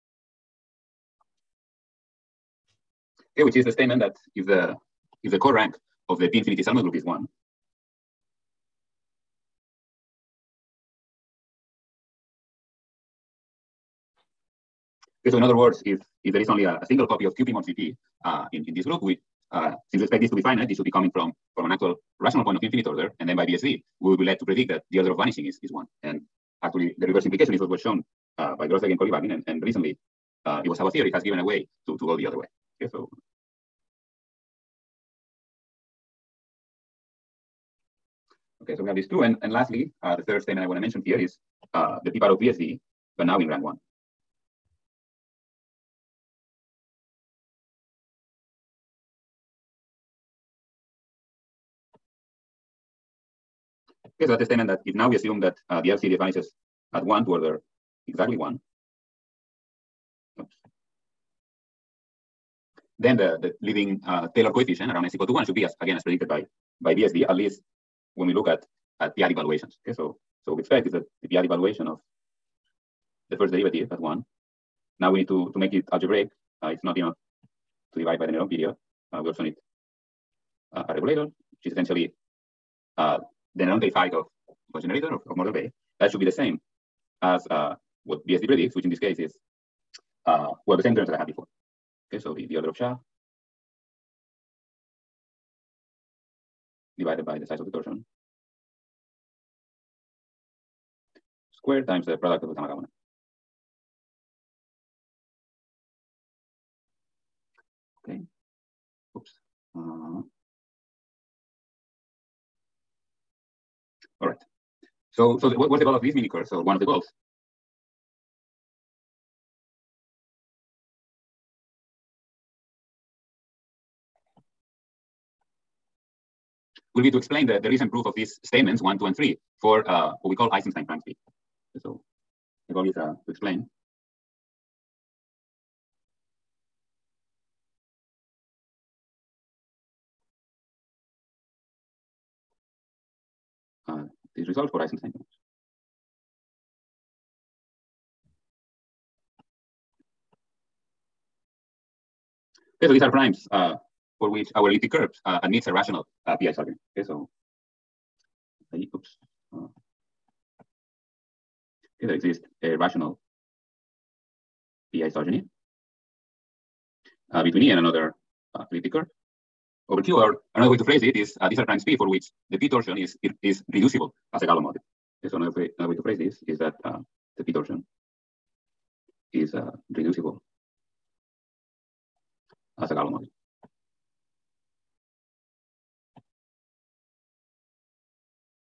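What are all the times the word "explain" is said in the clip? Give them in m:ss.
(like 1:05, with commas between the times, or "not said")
2:07, 2:13.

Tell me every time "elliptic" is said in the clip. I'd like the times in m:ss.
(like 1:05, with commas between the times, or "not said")
2:34, 2:48.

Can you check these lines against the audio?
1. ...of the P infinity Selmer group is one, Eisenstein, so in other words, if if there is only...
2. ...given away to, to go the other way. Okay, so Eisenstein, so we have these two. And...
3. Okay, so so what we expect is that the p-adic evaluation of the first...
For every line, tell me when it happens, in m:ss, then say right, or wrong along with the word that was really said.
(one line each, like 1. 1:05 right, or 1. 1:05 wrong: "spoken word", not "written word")
1. 0:06 wrong: "Okay", not "Eisenstein"
2. 0:31 wrong: "Okay", not "Eisenstein"
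3. 1:09 right.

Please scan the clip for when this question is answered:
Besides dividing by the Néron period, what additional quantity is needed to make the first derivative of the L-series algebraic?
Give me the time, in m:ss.
1:20.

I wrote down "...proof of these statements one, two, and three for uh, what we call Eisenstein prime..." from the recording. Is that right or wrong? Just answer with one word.
right.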